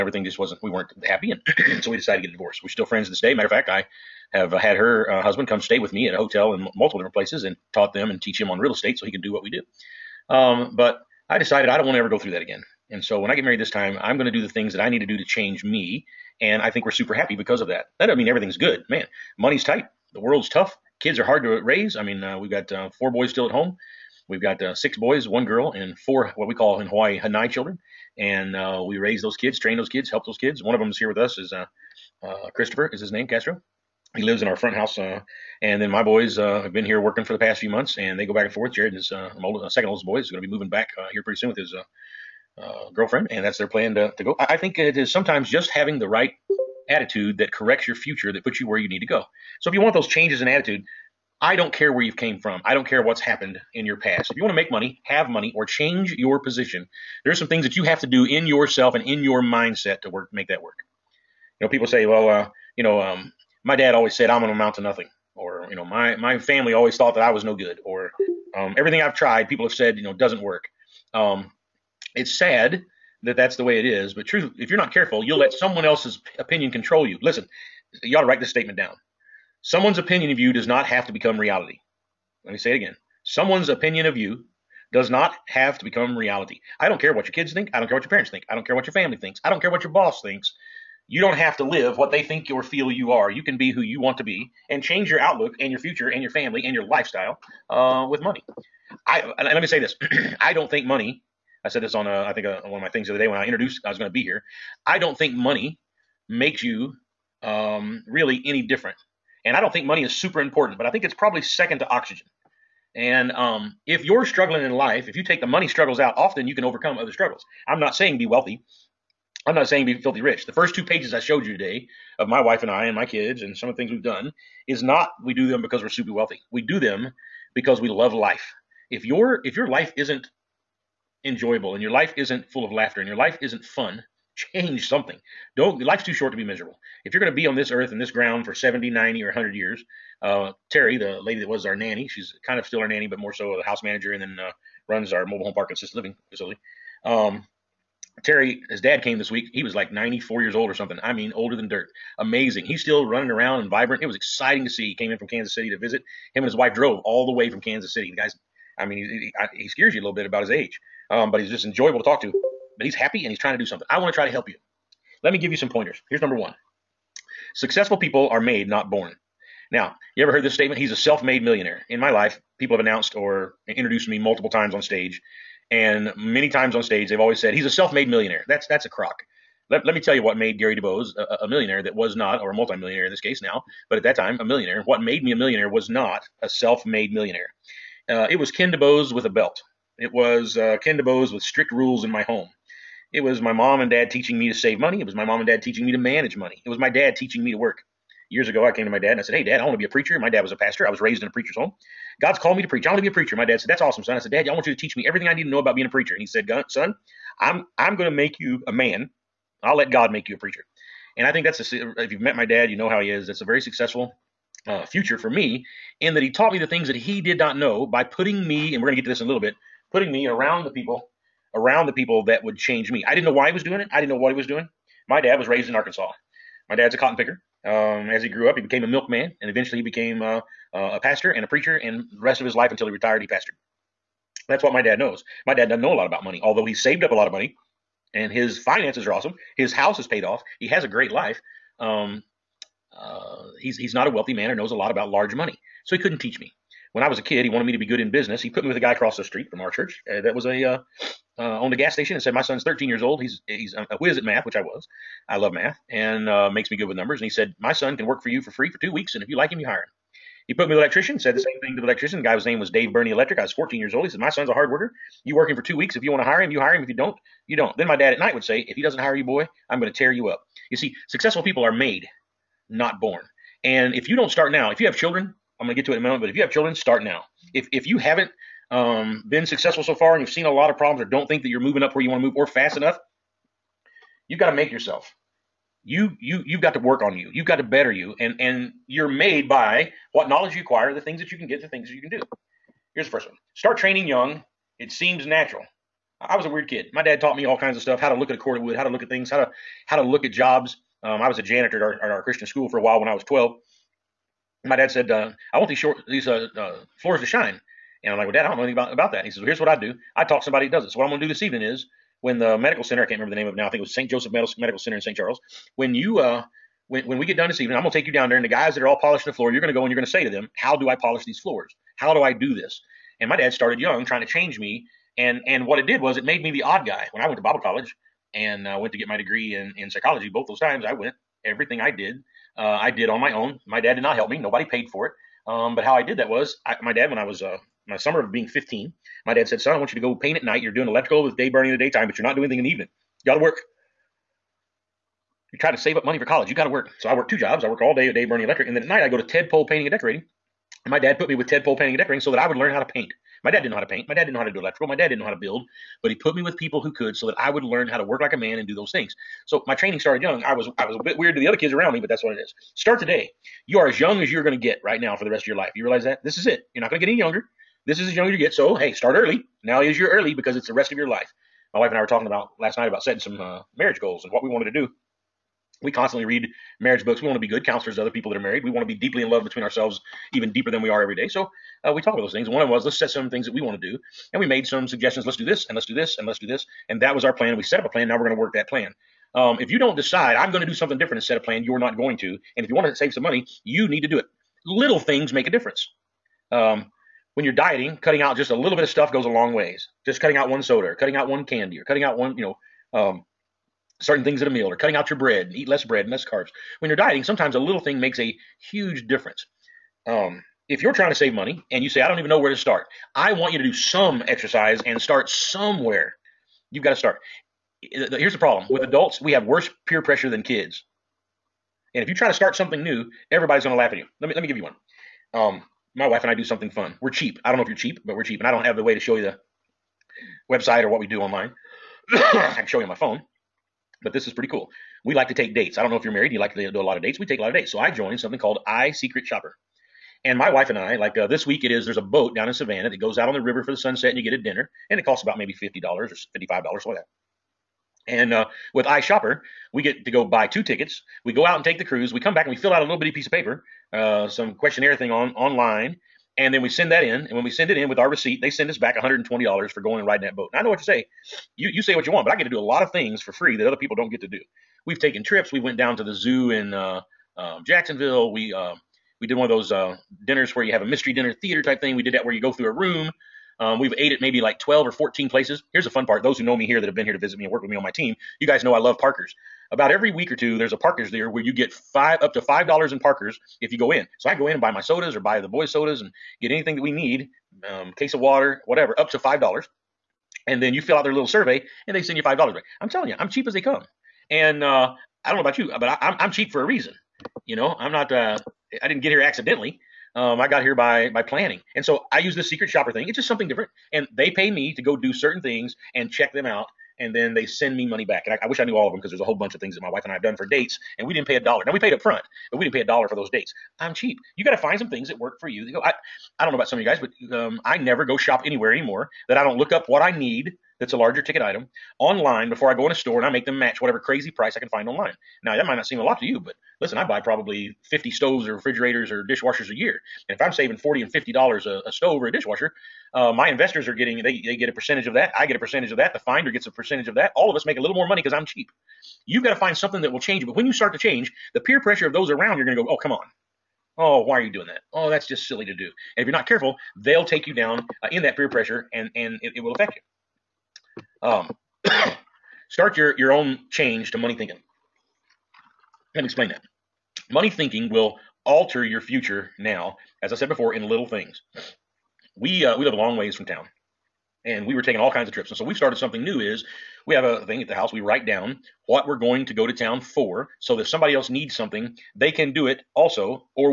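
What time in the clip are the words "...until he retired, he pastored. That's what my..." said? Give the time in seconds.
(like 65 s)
232 s.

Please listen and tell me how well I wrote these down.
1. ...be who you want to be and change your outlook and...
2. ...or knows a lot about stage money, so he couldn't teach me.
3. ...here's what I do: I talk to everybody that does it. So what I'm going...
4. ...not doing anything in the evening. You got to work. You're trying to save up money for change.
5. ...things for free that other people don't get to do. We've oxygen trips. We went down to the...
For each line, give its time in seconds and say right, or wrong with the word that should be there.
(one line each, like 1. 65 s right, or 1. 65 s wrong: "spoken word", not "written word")
1. 93 s right
2. 244 s wrong: "large", not "stage"
3. 309 s wrong: "somebody", not "everybody"
4. 342 s wrong: "college", not "change"
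5. 462 s wrong: "taken", not "oxygen".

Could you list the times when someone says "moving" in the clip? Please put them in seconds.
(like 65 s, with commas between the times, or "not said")
40 s, 281 s.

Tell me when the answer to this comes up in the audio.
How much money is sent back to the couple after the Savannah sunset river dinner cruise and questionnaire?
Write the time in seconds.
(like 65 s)
458 s.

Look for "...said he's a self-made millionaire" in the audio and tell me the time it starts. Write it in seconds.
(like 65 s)
177 s.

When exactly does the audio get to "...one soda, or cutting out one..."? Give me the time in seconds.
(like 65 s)
400 s.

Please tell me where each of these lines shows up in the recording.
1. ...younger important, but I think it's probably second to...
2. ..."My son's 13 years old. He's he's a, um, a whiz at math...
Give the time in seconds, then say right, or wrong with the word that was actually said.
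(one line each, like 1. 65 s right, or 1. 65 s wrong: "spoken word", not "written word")
1. 110 s wrong: "super", not "younger"
2. 252 s right.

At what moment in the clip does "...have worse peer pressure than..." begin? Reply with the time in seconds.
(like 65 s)
419 s.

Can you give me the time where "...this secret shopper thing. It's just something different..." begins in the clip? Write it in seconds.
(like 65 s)
502 s.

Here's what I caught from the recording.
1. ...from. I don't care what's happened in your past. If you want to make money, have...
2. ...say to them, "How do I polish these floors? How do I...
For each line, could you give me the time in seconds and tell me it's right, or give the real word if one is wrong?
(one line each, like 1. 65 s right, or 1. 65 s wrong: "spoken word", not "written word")
1. 52 s right
2. 320 s right.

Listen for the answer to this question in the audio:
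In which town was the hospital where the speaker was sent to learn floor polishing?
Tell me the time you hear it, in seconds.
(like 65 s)
314 s.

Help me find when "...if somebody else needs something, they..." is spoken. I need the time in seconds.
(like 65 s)
570 s.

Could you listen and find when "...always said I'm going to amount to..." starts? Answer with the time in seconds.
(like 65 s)
63 s.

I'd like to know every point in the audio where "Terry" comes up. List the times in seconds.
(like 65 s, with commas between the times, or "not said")
140 s, 148 s.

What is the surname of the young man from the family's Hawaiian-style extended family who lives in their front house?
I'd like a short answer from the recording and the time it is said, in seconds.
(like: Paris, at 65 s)
Castro, at 33 s.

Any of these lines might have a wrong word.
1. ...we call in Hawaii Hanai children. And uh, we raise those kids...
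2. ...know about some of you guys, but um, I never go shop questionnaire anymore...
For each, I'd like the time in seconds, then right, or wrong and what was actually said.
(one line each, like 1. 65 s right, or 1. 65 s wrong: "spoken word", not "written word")
1. 26 s right
2. 516 s wrong: "anywhere", not "questionnaire".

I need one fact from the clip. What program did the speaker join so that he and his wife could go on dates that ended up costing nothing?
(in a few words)
I Secret Shopper.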